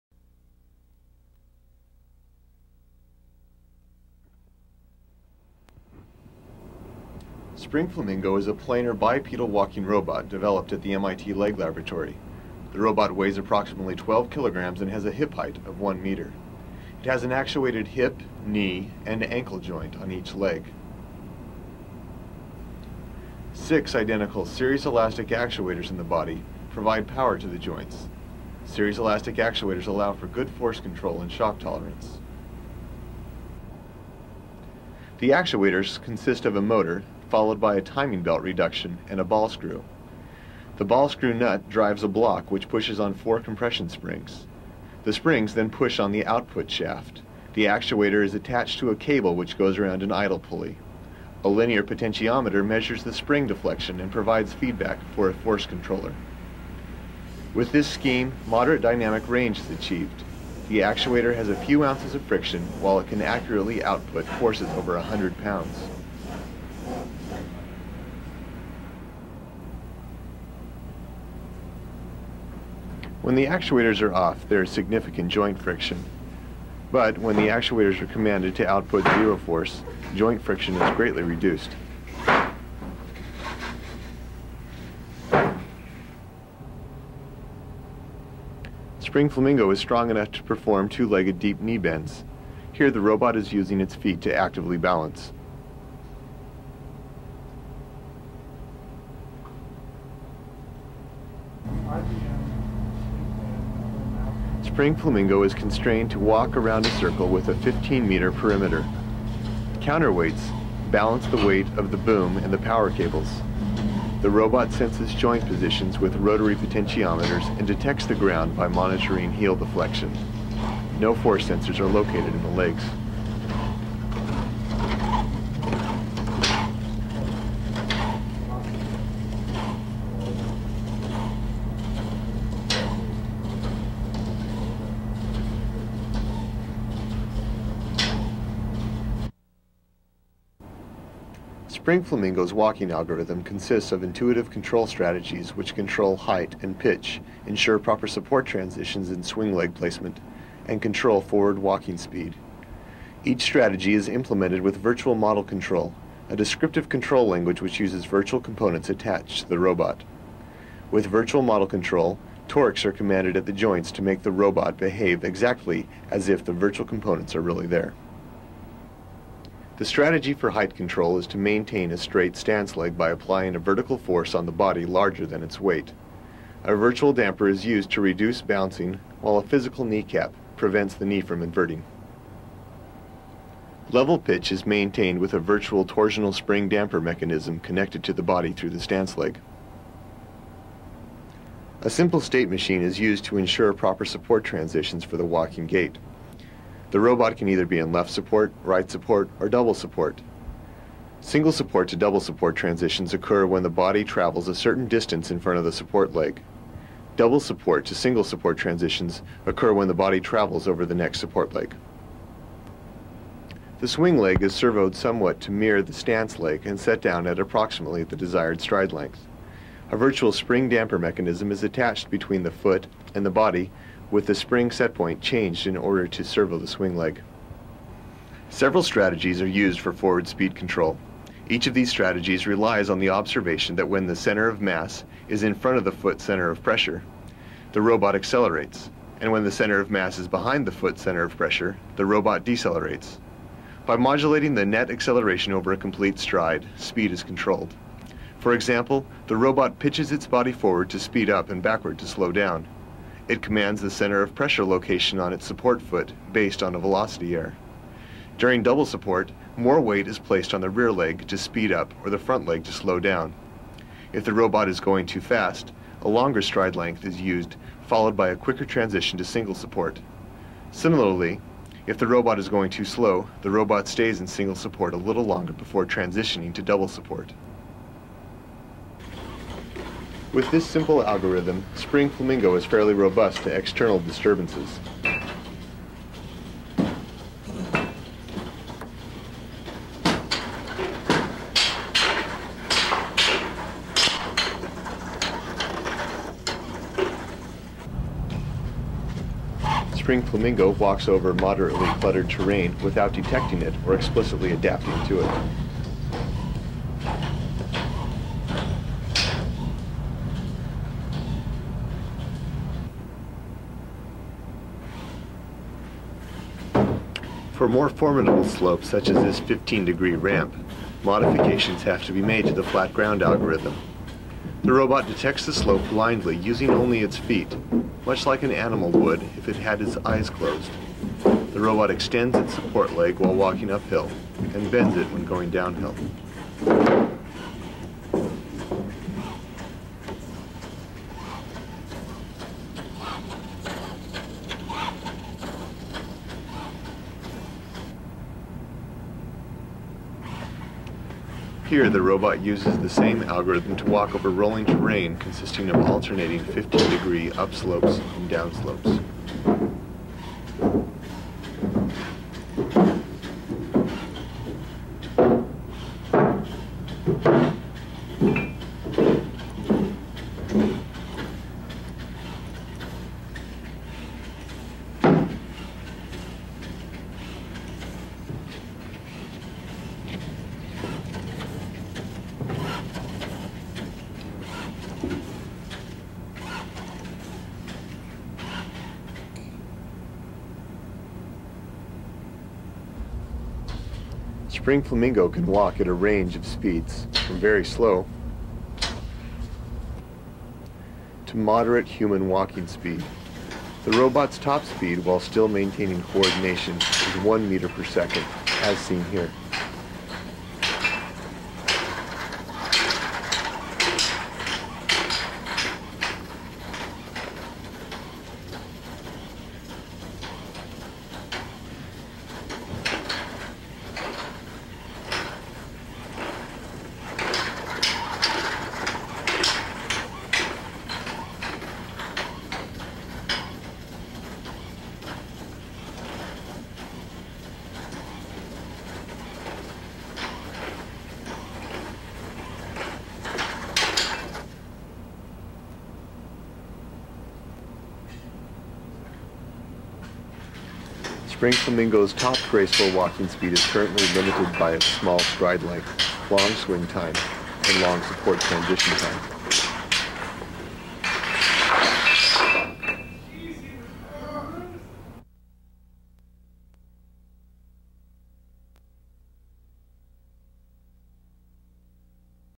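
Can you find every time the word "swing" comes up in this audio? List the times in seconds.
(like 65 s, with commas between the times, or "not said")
149 s, 213 s, 226 s, 456 s.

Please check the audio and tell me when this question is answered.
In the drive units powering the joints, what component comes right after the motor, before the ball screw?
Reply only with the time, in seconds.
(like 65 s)
37 s.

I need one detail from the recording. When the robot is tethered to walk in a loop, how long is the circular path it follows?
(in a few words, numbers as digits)
15 meters.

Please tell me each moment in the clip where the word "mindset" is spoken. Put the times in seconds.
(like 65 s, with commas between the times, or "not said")
not said.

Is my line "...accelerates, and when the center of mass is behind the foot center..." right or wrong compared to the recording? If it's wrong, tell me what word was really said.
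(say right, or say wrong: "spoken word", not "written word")
right.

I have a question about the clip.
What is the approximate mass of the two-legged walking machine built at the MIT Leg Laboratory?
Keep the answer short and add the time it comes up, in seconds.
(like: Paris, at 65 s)
12 kilograms, at 13 s.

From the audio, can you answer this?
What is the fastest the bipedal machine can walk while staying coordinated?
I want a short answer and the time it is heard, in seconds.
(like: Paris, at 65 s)
1 meter per second, at 407 s.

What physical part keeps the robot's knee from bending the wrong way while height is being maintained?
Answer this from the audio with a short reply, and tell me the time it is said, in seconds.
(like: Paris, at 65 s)
kneecap, at 179 s.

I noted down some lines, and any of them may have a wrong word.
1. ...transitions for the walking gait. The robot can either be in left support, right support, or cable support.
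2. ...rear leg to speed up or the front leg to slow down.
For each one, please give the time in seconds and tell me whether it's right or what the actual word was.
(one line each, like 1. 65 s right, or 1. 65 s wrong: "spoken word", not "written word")
1. 194 s wrong: "double", not "cable"
2. 260 s right.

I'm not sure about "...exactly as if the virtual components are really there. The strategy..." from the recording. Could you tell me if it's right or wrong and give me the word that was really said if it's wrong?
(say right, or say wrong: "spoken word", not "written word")
right.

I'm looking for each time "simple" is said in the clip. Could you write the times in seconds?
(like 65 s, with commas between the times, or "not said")
191 s, 280 s.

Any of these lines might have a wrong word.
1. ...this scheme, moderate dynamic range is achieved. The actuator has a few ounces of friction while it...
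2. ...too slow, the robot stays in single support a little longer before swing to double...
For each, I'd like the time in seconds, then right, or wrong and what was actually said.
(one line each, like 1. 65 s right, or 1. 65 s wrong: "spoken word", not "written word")
1. 57 s right
2. 272 s wrong: "transitioning", not "swing".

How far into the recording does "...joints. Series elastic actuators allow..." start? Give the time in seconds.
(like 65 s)
27 s.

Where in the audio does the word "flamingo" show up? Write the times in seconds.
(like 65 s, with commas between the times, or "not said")
7 s, 89 s, 104 s, 142 s, 282 s, 300 s, 394 s, 451 s.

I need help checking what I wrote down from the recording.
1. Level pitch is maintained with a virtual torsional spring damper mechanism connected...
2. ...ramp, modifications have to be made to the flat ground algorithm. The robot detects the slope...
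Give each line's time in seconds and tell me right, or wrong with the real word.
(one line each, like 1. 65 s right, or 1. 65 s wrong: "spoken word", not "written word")
1. 183 s right
2. 320 s right.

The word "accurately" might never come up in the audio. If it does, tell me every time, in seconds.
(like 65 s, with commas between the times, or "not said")
63 s.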